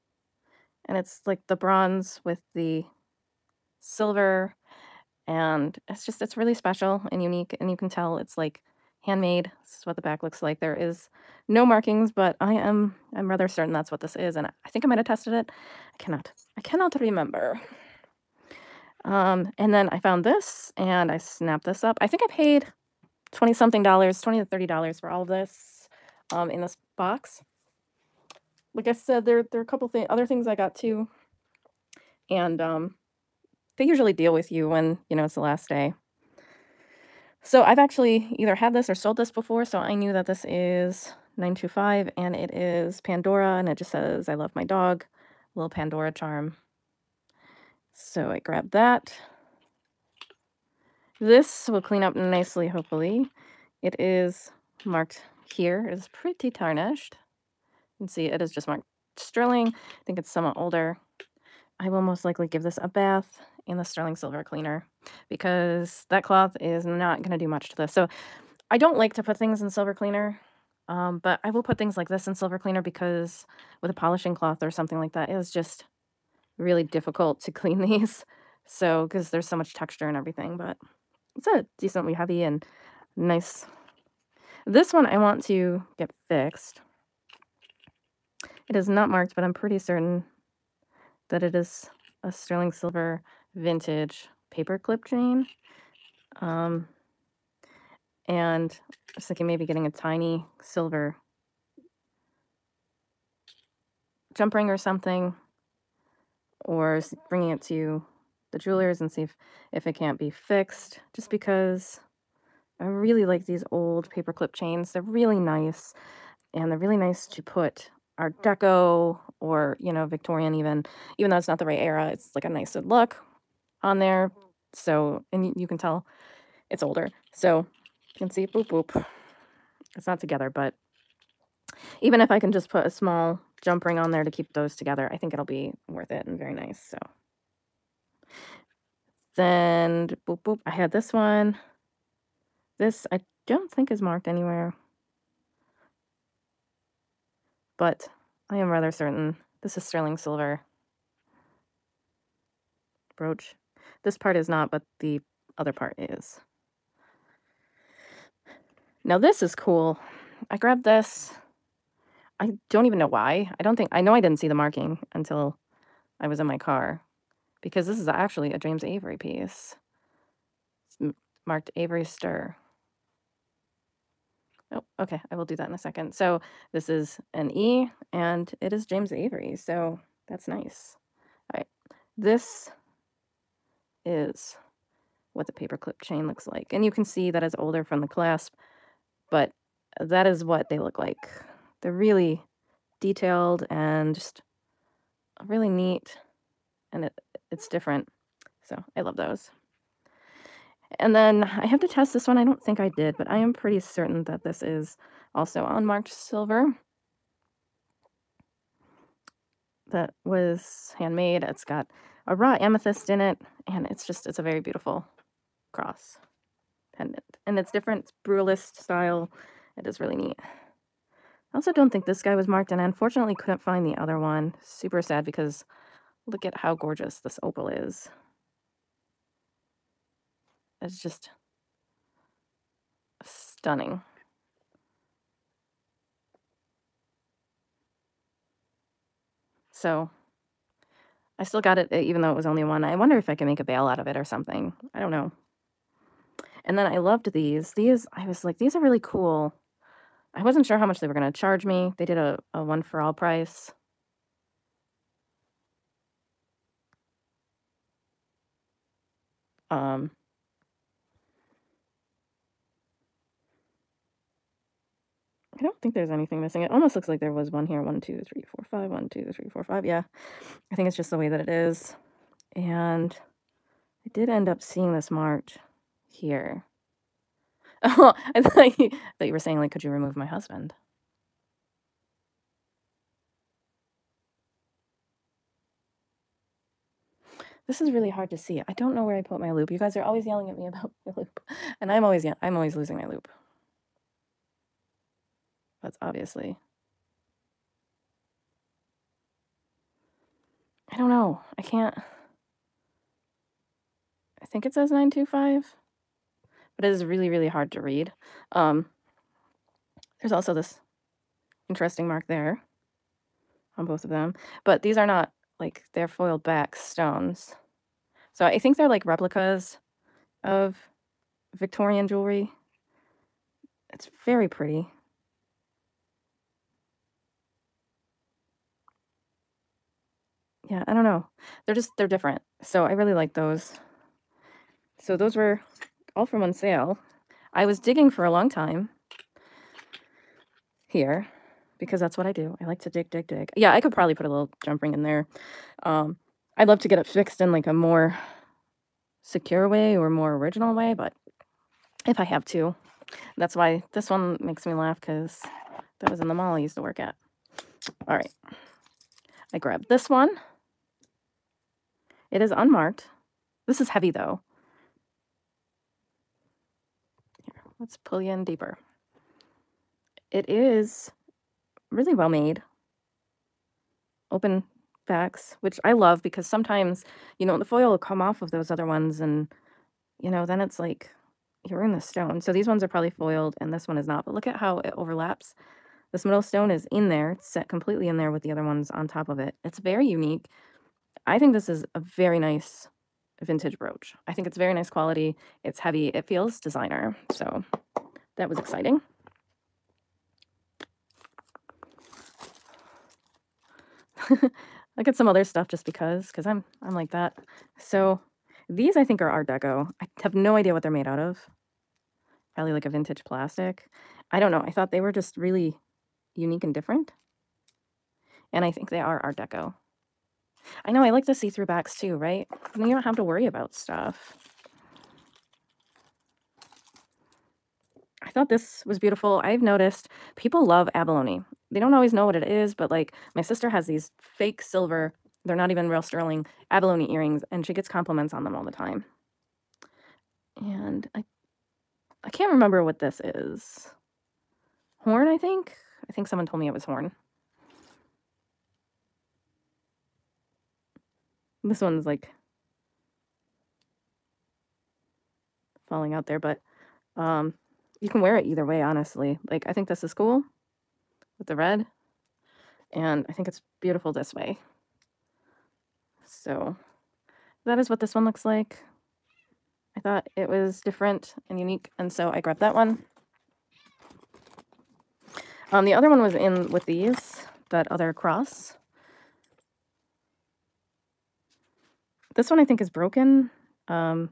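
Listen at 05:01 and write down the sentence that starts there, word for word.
I can't I think it says 925.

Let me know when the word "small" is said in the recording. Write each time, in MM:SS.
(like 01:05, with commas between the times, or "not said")
02:12.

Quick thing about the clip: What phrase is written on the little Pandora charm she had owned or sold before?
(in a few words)
I love my dog.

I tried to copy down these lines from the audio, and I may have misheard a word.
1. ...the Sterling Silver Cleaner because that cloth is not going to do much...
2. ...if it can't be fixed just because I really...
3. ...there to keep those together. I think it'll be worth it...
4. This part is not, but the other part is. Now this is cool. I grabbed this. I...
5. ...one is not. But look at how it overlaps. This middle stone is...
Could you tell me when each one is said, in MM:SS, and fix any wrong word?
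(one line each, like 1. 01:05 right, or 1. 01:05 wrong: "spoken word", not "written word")
1. 01:03 right
2. 01:49 right
3. 02:14 right
4. 02:34 right
5. 06:23 right.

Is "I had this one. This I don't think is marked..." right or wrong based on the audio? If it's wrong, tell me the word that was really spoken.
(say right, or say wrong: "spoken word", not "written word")
right.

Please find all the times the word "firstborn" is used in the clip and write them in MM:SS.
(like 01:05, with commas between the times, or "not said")
not said.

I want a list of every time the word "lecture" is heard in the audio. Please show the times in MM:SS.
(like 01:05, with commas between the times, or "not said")
not said.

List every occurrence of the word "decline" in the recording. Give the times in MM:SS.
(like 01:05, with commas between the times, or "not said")
not said.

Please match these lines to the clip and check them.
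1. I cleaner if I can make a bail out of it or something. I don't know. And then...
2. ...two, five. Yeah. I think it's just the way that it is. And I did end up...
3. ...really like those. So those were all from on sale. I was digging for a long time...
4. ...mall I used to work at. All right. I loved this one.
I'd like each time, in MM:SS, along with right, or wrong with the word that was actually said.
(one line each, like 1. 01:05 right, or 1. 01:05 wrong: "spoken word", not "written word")
1. 04:02 wrong: "wonder", not "cleaner"
2. 04:29 wrong: "four", not "two"
3. 05:32 right
4. 05:56 wrong: "grabbed", not "loved".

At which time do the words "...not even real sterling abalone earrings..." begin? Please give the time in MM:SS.
07:15.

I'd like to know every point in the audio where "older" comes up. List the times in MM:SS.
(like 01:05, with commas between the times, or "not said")
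01:00, 02:06, 03:07.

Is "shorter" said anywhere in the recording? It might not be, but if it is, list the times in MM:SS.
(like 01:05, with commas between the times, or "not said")
not said.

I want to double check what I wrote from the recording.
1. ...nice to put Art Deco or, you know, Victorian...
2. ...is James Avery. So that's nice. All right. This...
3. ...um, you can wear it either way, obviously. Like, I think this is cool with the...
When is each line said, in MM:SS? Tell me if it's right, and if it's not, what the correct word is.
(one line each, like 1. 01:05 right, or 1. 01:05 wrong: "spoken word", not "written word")
1. 01:56 right
2. 02:58 right
3. 07:37 wrong: "honestly", not "obviously".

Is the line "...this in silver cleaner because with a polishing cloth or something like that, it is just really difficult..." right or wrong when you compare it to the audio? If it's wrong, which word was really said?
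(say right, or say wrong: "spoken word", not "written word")
right.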